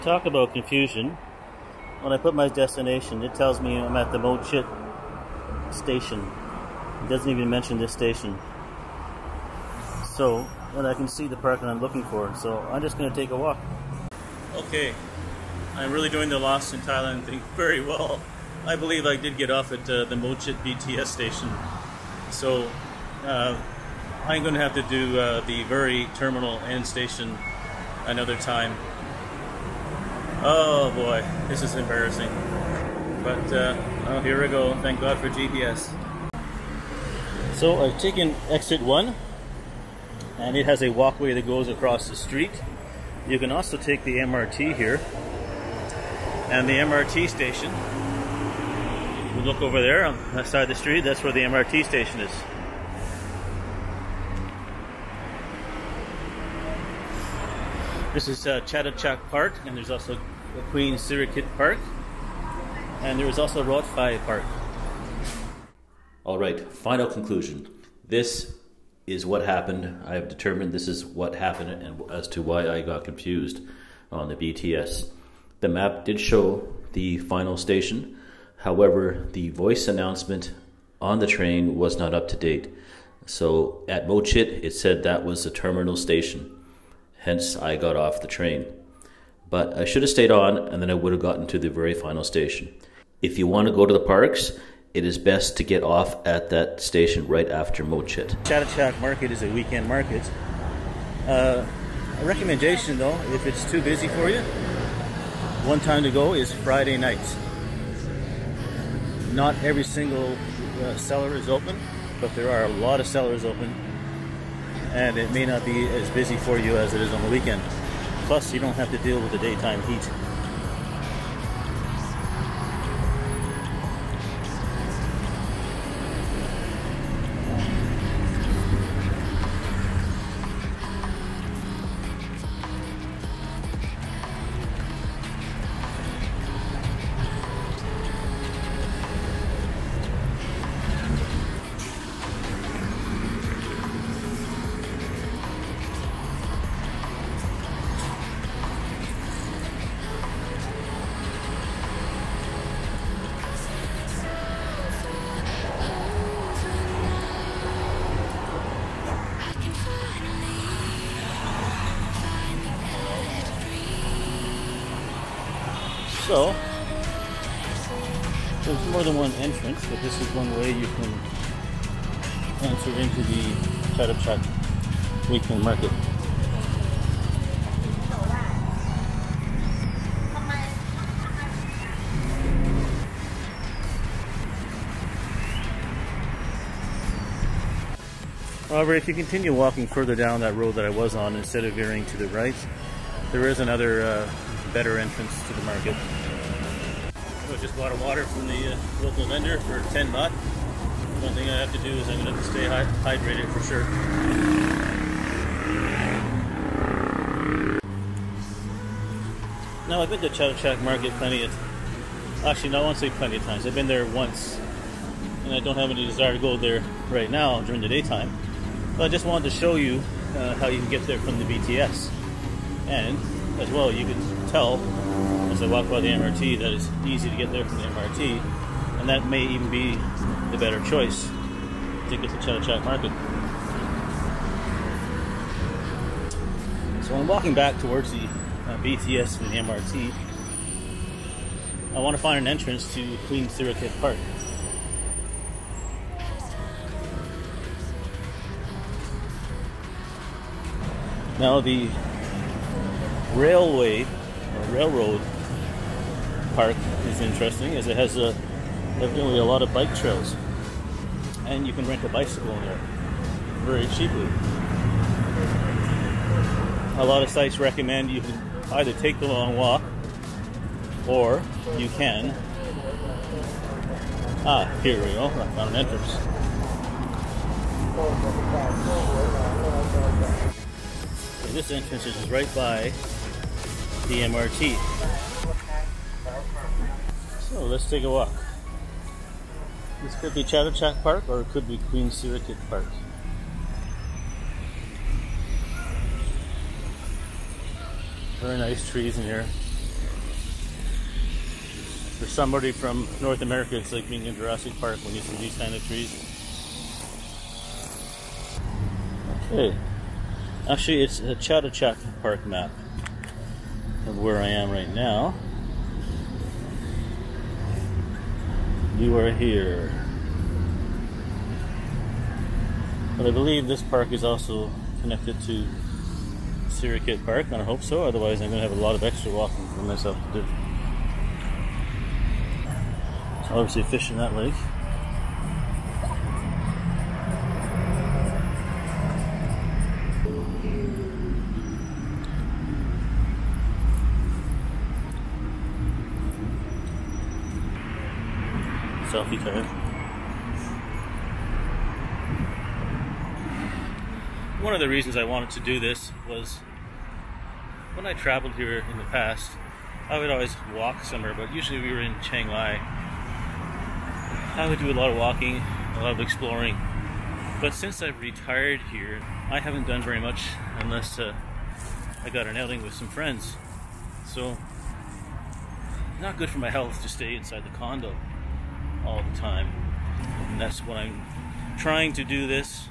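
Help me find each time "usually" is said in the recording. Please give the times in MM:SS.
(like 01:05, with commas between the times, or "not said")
06:01.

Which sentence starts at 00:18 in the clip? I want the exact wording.
I believe I did get off at uh, the Mo Chit BTS station.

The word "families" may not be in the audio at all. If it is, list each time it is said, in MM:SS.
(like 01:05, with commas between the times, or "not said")
not said.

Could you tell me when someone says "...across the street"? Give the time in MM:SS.
00:41.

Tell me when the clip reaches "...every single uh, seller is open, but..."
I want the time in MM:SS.
01:49.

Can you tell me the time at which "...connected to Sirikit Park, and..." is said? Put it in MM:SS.
05:25.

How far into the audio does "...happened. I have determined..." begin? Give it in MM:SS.
01:09.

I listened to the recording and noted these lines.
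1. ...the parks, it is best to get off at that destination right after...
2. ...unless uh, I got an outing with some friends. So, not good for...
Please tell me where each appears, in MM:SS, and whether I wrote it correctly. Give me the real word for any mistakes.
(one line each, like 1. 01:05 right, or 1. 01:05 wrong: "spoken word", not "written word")
1. 01:33 wrong: "station", not "destination"
2. 06:10 right.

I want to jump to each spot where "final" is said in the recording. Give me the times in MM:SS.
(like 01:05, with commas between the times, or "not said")
01:06, 01:17, 01:31.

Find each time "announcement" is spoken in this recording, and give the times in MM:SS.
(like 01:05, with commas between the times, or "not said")
01:19.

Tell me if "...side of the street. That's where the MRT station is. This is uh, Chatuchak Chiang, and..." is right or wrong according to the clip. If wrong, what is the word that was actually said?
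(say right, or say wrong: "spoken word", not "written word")
wrong: "Park", not "Chiang".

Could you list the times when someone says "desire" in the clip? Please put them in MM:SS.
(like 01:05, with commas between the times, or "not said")
03:36.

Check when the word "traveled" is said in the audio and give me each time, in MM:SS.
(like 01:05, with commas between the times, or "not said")
05:58.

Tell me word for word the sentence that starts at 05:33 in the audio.
So obviously fish in that lake.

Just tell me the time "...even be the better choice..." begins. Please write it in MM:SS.
03:49.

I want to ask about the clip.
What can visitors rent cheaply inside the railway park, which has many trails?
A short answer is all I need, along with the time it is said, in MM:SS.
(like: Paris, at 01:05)
A bicycle, at 04:22.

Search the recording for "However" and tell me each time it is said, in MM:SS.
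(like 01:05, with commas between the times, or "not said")
01:18, 03:08.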